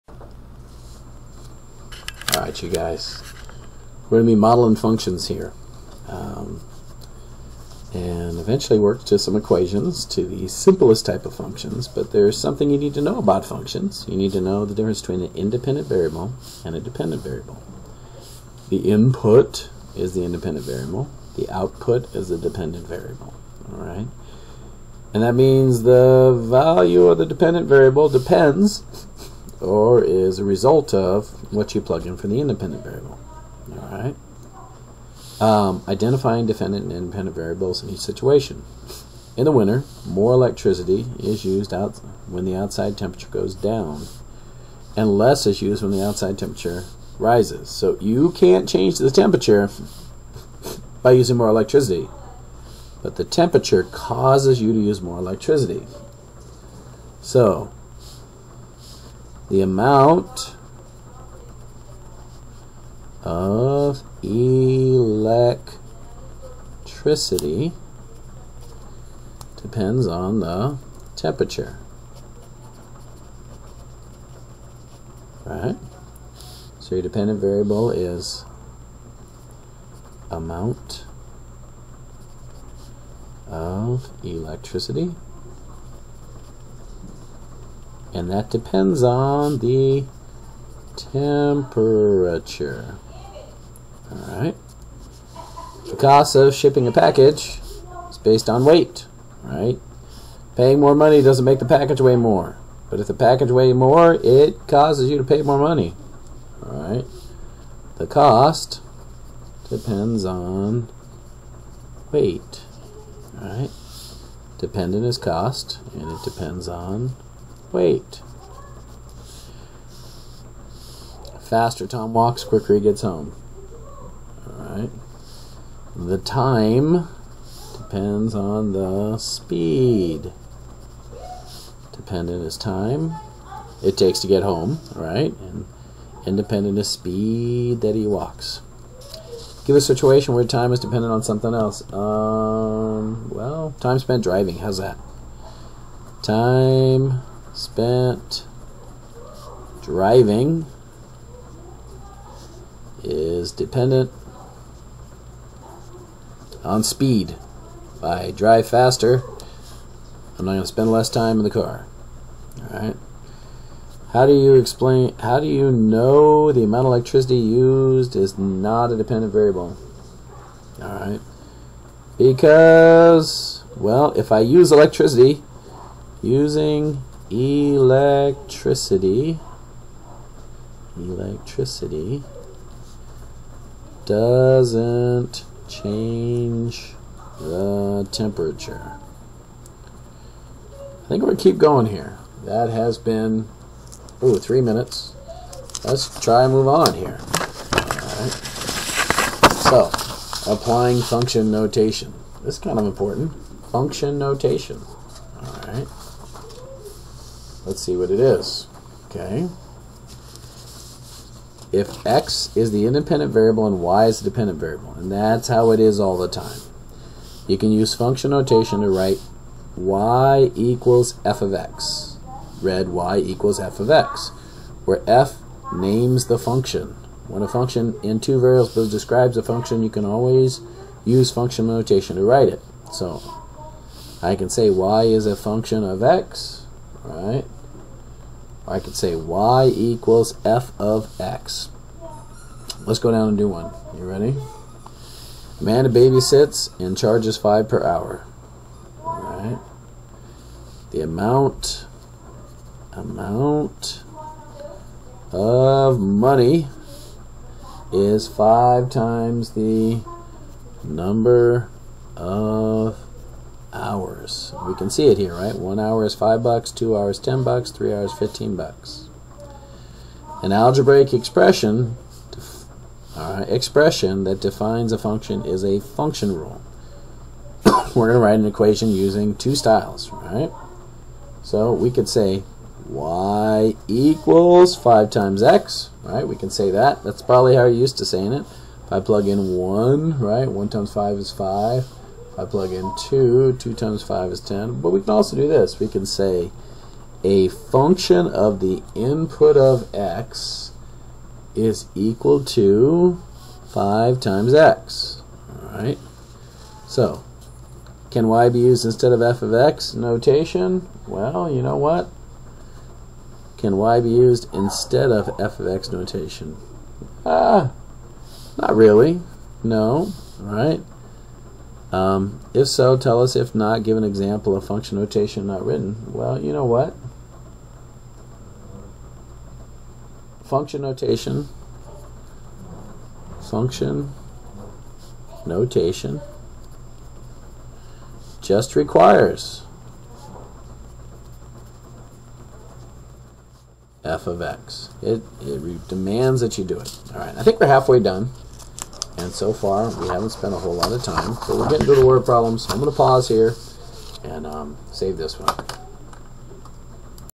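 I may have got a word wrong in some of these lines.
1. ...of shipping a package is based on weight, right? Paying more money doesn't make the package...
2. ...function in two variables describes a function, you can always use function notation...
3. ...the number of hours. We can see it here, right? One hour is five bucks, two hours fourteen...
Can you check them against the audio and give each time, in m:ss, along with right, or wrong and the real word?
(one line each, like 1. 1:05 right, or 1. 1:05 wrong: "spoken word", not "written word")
1. 1:36 right
2. 3:47 right
3. 4:19 wrong: "ten", not "fourteen".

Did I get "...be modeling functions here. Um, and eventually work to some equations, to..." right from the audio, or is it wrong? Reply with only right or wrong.
right.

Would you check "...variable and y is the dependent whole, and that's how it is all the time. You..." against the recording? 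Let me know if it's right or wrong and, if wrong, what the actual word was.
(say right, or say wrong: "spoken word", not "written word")
wrong: "variable", not "whole".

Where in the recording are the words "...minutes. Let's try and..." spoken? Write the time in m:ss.
3:14.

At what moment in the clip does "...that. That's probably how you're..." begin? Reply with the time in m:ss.
4:46.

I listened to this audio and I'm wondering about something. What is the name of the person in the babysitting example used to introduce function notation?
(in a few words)
Amanda.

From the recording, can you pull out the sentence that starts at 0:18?
The input is the independent variable.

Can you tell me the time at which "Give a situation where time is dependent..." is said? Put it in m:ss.
2:19.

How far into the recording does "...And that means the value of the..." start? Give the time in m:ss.
0:25.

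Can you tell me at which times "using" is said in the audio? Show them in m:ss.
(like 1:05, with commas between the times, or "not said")
0:51, 2:56, 4:38.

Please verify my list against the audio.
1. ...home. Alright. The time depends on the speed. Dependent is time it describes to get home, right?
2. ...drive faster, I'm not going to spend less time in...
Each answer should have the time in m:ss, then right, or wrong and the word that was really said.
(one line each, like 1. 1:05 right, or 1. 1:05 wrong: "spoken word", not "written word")
1. 2:03 wrong: "takes", not "describes"
2. 2:38 right.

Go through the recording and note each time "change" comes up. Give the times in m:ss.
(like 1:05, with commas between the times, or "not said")
0:48, 3:05.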